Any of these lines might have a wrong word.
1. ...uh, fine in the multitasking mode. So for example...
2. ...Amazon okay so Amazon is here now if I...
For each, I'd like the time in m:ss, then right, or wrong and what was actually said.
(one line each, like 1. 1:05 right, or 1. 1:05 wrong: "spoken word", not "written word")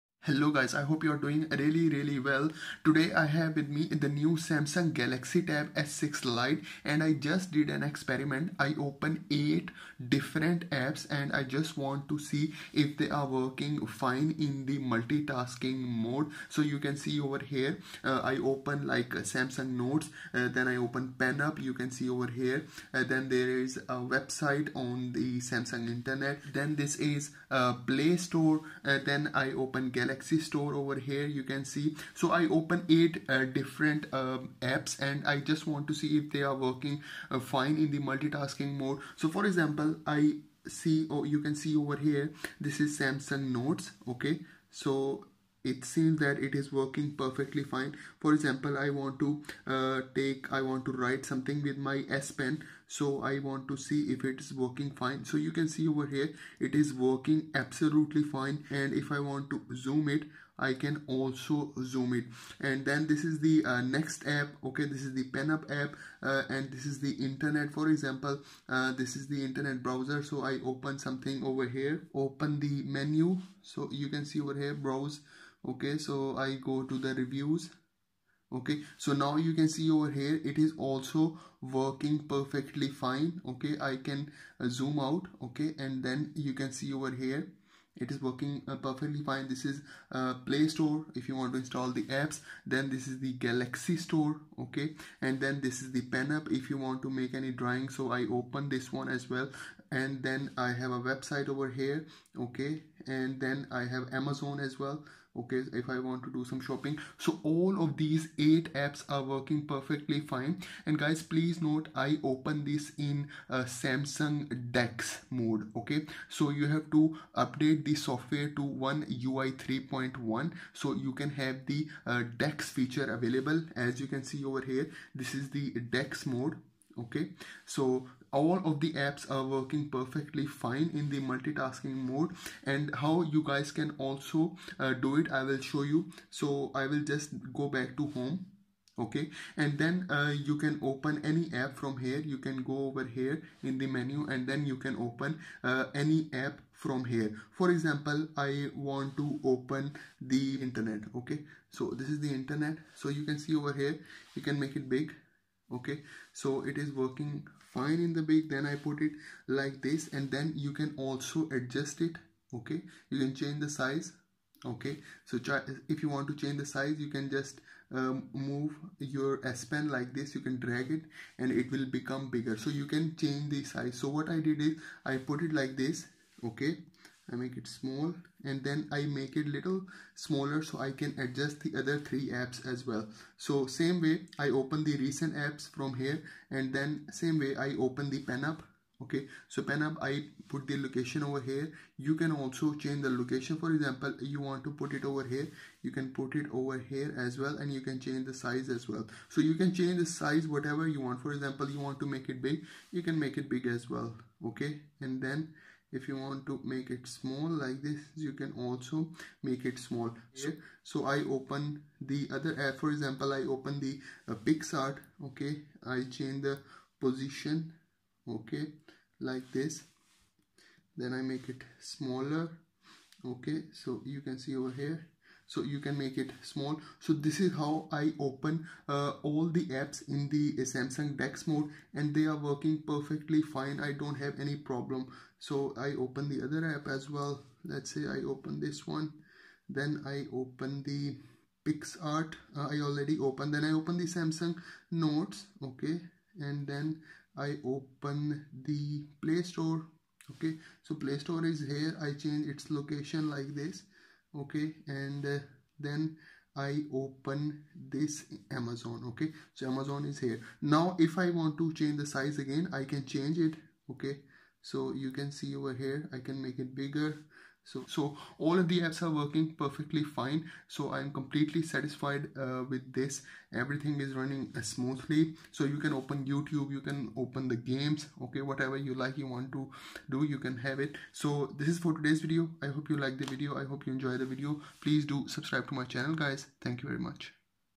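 1. 0:37 right
2. 4:18 right.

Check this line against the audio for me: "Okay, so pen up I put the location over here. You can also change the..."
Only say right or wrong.
right.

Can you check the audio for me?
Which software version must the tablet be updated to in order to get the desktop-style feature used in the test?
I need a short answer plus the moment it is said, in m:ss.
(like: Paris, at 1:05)
One UI 3.1, at 1:58.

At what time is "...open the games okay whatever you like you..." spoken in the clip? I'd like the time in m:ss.
4:37.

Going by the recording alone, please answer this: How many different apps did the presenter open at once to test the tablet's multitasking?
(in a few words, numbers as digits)
8.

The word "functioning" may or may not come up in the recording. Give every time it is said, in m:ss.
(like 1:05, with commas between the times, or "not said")
not said.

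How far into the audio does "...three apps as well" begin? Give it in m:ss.
3:01.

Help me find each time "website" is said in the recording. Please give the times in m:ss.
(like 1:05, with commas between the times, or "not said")
0:24, 1:40.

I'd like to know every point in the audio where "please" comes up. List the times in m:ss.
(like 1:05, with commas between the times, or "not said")
1:51, 4:44.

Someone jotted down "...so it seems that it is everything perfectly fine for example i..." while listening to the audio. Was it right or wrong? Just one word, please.
wrong.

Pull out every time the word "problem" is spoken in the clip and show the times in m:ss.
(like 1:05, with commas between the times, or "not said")
3:54.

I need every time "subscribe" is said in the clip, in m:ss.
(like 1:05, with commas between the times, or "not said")
4:45.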